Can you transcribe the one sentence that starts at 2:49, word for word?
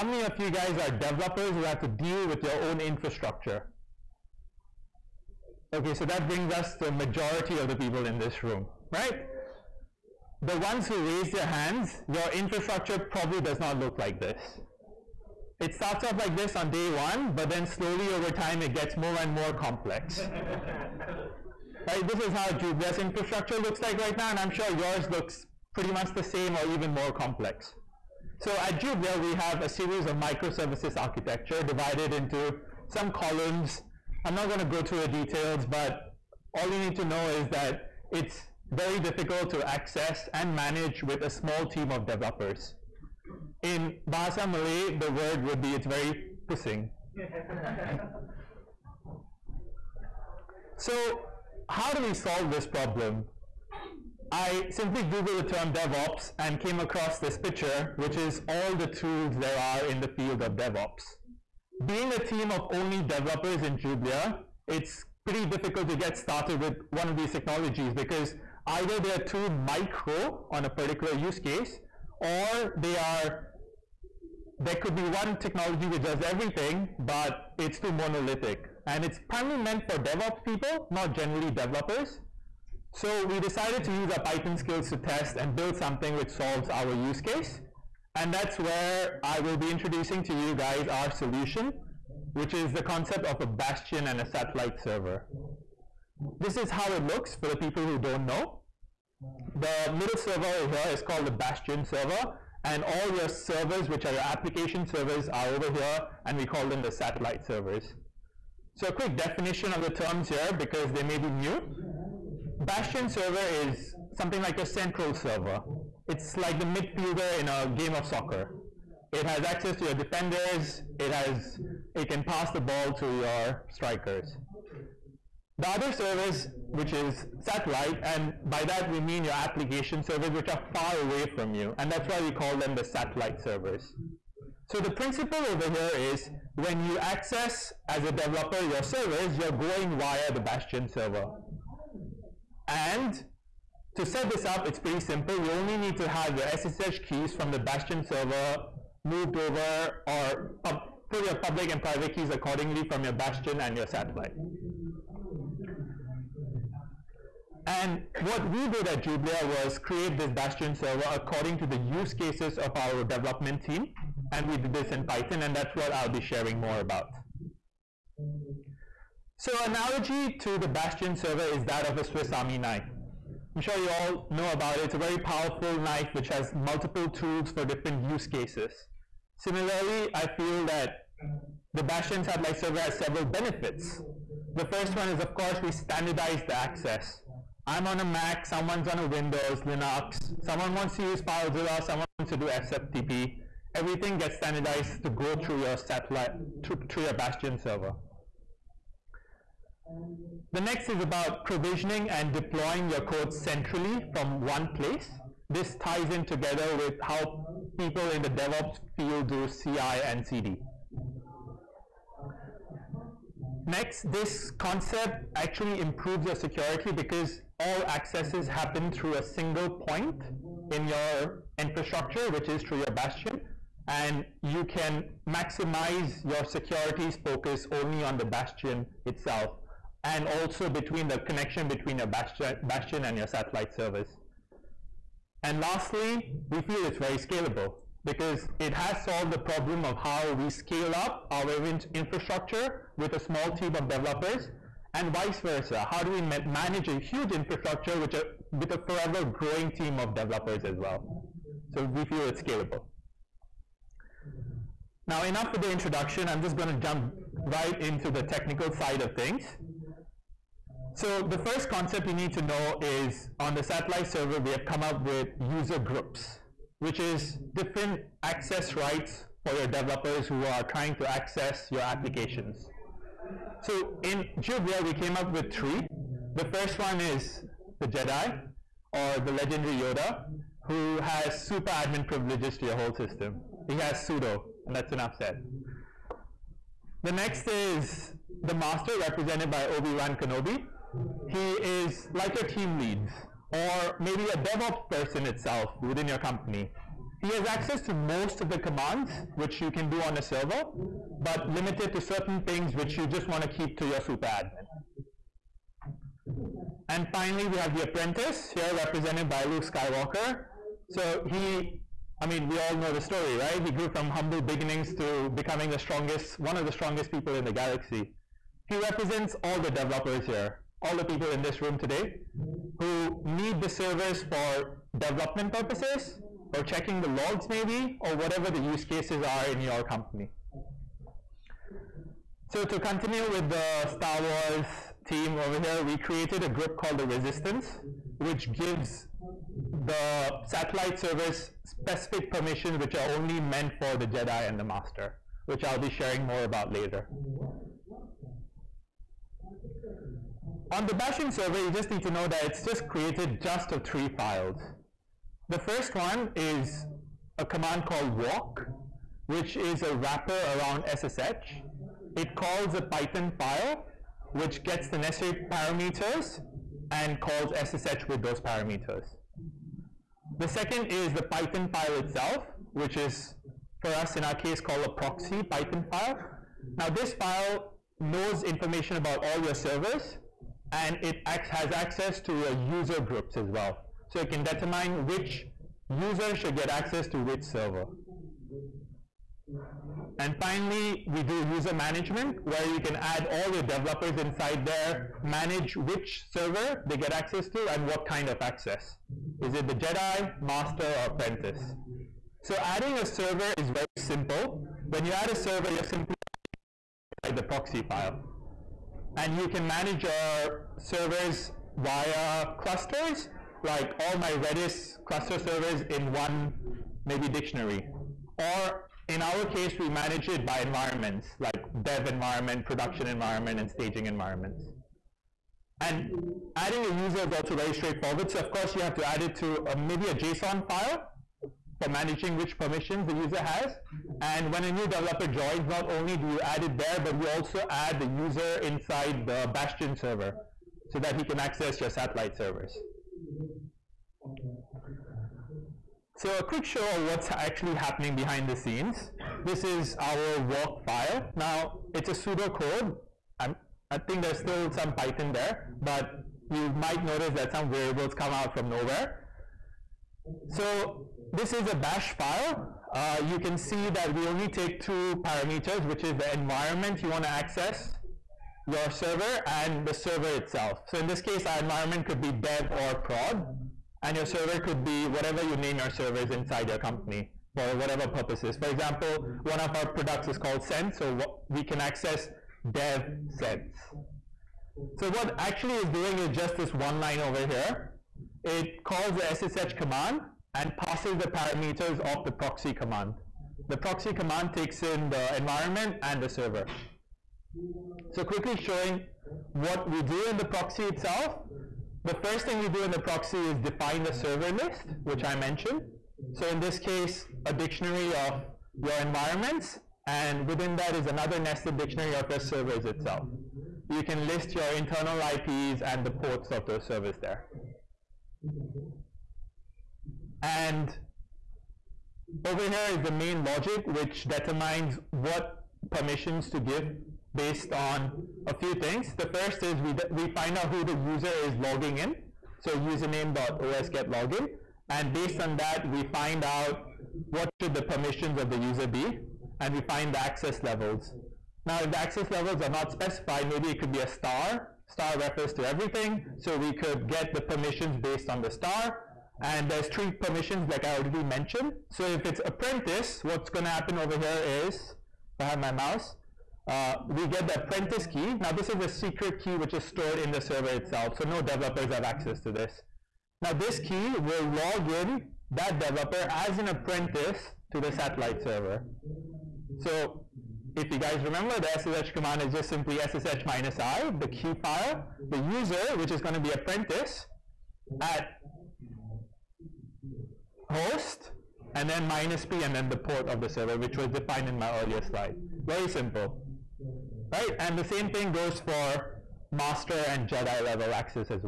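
So analogy to the Bastion server is that of a Swiss Army knife.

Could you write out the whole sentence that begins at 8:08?
It calls the SSH command and passes the parameters of the proxy command.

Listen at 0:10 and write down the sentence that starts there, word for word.
The ones who raised their hands, your infrastructure probably does not look like this.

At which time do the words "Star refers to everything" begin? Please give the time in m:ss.
9:04.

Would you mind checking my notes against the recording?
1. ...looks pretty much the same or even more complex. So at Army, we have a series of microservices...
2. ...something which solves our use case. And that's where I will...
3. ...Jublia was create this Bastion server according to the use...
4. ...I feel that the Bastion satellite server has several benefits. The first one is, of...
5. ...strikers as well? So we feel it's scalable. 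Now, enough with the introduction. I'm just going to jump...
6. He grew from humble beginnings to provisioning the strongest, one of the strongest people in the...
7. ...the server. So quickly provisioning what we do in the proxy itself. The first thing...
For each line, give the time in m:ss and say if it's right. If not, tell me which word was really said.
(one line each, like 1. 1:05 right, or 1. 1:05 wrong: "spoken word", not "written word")
1. 0:25 wrong: "Jublia", not "Army"
2. 1:25 right
3. 2:39 right
4. 3:00 right
5. 4:10 wrong: "developers", not "strikers"
6. 5:13 wrong: "becoming", not "provisioning"
7. 8:16 wrong: "showing", not "provisioning".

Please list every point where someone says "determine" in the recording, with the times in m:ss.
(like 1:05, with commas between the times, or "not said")
6:24, 8:44.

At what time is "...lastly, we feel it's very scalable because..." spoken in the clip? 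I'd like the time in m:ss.
3:55.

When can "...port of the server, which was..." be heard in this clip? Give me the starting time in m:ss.
9:42.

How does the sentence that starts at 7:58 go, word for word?
For example, one of our products is called Sense, so we can access dev sense.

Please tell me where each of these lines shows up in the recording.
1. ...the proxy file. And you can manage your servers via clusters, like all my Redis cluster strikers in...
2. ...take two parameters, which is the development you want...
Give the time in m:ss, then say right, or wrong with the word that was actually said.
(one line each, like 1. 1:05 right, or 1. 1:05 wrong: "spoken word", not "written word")
1. 6:47 wrong: "servers", not "strikers"
2. 7:44 wrong: "environment", not "development".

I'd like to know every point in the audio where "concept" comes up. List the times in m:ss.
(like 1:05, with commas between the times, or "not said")
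1:32, 3:34, 4:21.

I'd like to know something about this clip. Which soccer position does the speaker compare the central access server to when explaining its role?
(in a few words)
Midfielder.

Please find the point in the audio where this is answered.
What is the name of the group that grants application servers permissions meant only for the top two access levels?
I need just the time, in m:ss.
5:36.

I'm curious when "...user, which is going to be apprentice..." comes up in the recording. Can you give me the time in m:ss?
9:35.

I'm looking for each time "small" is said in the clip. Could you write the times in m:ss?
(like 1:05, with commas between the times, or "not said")
0:41, 4:03.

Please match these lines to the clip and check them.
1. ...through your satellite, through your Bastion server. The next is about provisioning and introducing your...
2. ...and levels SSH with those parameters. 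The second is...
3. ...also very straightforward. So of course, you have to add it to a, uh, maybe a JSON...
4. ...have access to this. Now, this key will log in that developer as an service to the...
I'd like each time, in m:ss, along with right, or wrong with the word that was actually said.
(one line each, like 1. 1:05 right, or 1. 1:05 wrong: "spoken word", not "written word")
1. 3:15 wrong: "deploying", not "introducing"
2. 6:06 wrong: "calls", not "levels"
3. 7:07 right
4. 9:21 wrong: "apprentice", not "service".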